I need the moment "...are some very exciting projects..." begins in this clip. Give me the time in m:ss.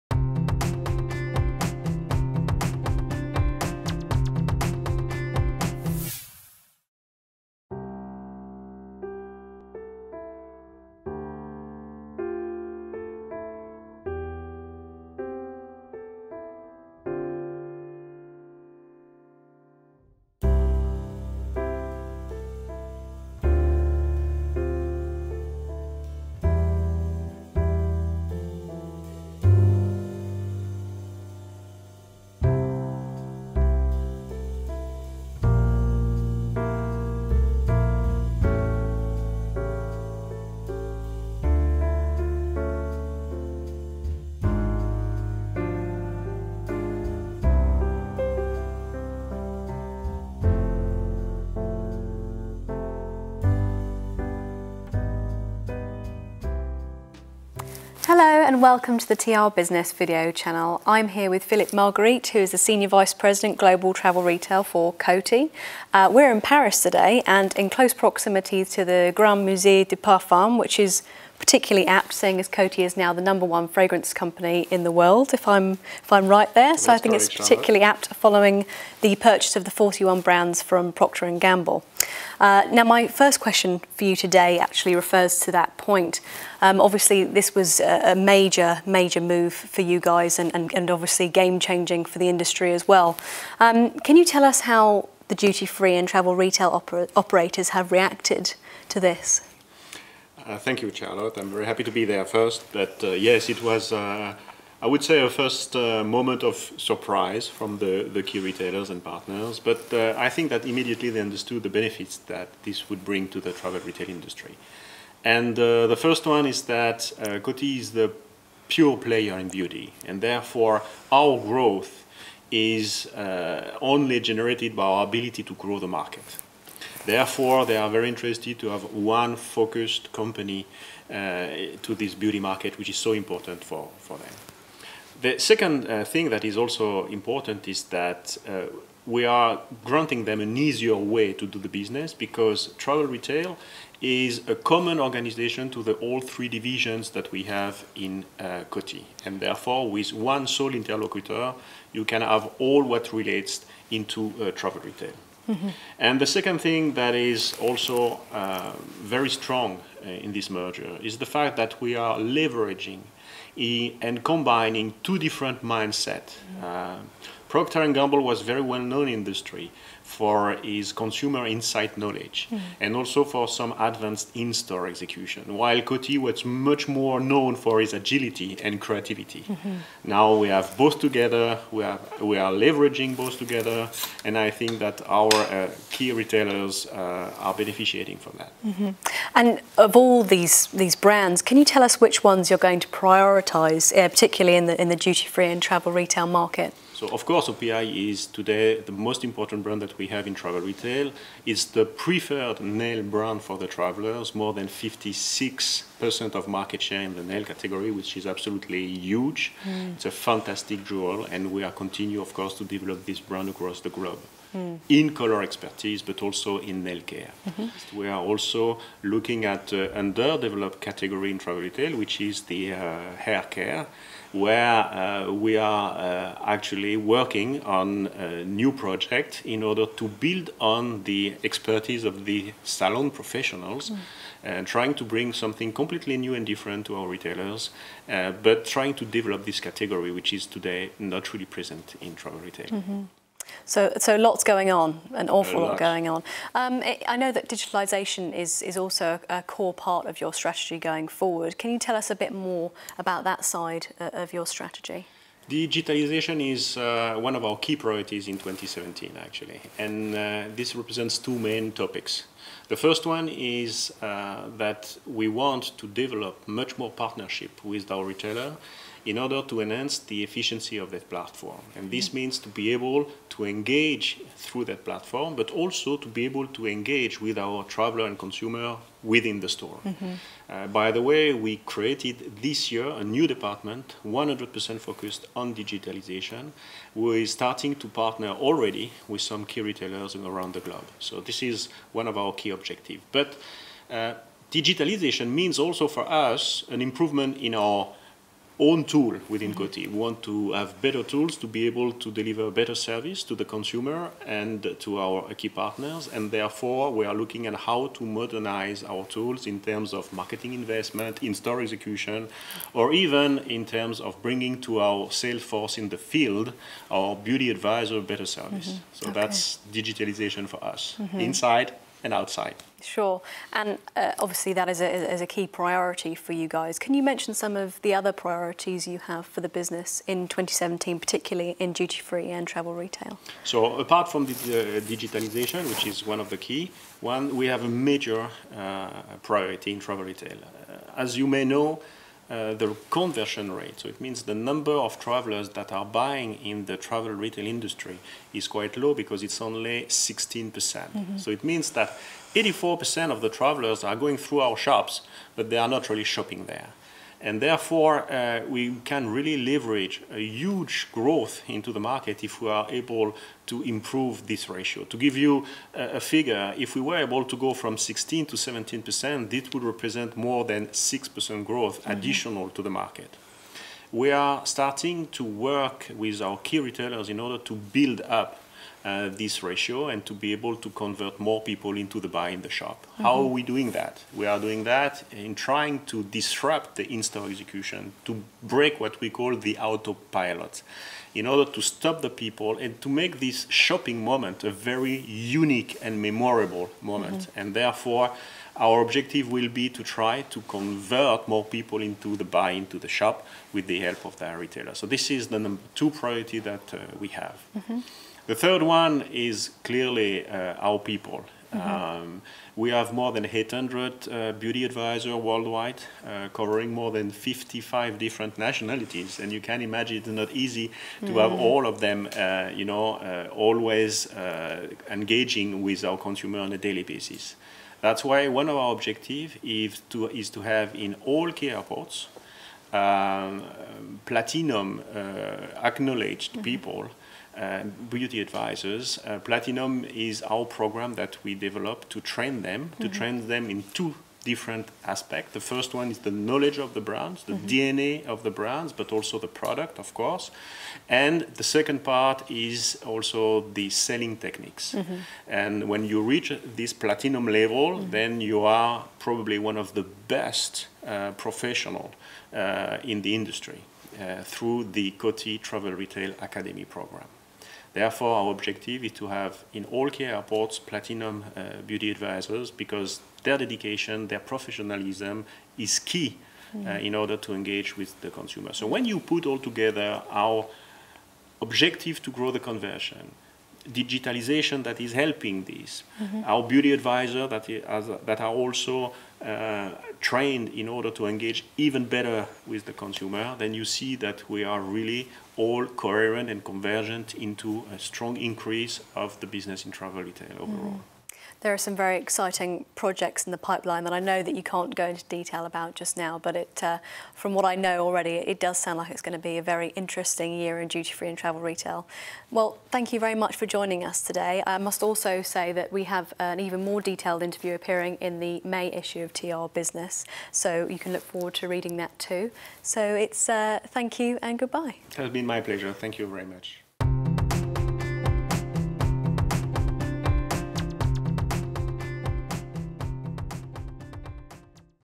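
8:21.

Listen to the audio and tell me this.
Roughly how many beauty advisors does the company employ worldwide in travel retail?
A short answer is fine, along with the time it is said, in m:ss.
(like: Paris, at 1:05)
More than 800, at 6:52.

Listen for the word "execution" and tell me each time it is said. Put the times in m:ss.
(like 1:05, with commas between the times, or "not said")
2:54, 5:11, 6:27.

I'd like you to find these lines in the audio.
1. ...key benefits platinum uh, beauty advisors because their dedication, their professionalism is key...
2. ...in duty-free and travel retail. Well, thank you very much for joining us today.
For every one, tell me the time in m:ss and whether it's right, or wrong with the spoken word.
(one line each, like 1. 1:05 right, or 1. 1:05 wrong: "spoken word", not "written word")
1. 7:49 wrong: "airports", not "benefits"
2. 8:30 right.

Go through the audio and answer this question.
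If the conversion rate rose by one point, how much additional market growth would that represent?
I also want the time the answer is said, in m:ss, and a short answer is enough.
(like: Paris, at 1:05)
More than 6%, at 6:10.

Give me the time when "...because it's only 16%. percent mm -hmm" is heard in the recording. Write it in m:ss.
5:48.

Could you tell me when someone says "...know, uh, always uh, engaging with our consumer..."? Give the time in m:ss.
7:02.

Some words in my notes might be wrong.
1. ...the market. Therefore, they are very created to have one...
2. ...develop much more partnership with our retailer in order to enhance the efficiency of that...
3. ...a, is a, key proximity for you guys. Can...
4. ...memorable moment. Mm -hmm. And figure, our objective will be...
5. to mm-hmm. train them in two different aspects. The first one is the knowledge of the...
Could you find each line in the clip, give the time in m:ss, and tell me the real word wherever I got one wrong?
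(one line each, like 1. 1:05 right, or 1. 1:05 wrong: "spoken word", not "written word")
1. 2:05 wrong: "interested", not "created"
2. 4:25 right
3. 5:24 wrong: "priority", not "proximity"
4. 6:35 wrong: "therefore", not "figure"
5. 7:22 right.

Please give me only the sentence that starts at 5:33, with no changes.
So apart from the, uh, digitalization, which is one of the key, one we have a major uh, priority in travel retail.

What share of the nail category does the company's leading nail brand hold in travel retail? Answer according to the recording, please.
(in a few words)
More than 56%.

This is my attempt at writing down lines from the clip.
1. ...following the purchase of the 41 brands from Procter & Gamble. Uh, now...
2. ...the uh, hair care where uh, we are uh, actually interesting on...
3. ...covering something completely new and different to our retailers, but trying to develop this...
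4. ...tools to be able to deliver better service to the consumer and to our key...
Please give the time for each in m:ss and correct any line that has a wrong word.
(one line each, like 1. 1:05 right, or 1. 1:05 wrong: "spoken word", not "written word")
1. 1:18 right
2. 3:42 wrong: "working", not "interesting"
3. 3:55 wrong: "bring", not "covering"
4. 5:01 right.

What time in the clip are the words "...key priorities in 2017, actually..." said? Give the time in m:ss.
4:17.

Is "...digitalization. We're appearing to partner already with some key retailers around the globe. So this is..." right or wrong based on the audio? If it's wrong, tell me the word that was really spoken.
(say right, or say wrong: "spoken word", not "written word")
wrong: "starting", not "appearing".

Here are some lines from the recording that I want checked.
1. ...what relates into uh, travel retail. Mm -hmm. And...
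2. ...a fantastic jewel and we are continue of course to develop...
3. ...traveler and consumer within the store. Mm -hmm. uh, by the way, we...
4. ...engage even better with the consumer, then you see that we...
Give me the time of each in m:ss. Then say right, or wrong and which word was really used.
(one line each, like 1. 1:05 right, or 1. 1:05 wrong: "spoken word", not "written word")
1. 2:32 right
2. 3:30 right
3. 4:37 right
4. 8:11 right.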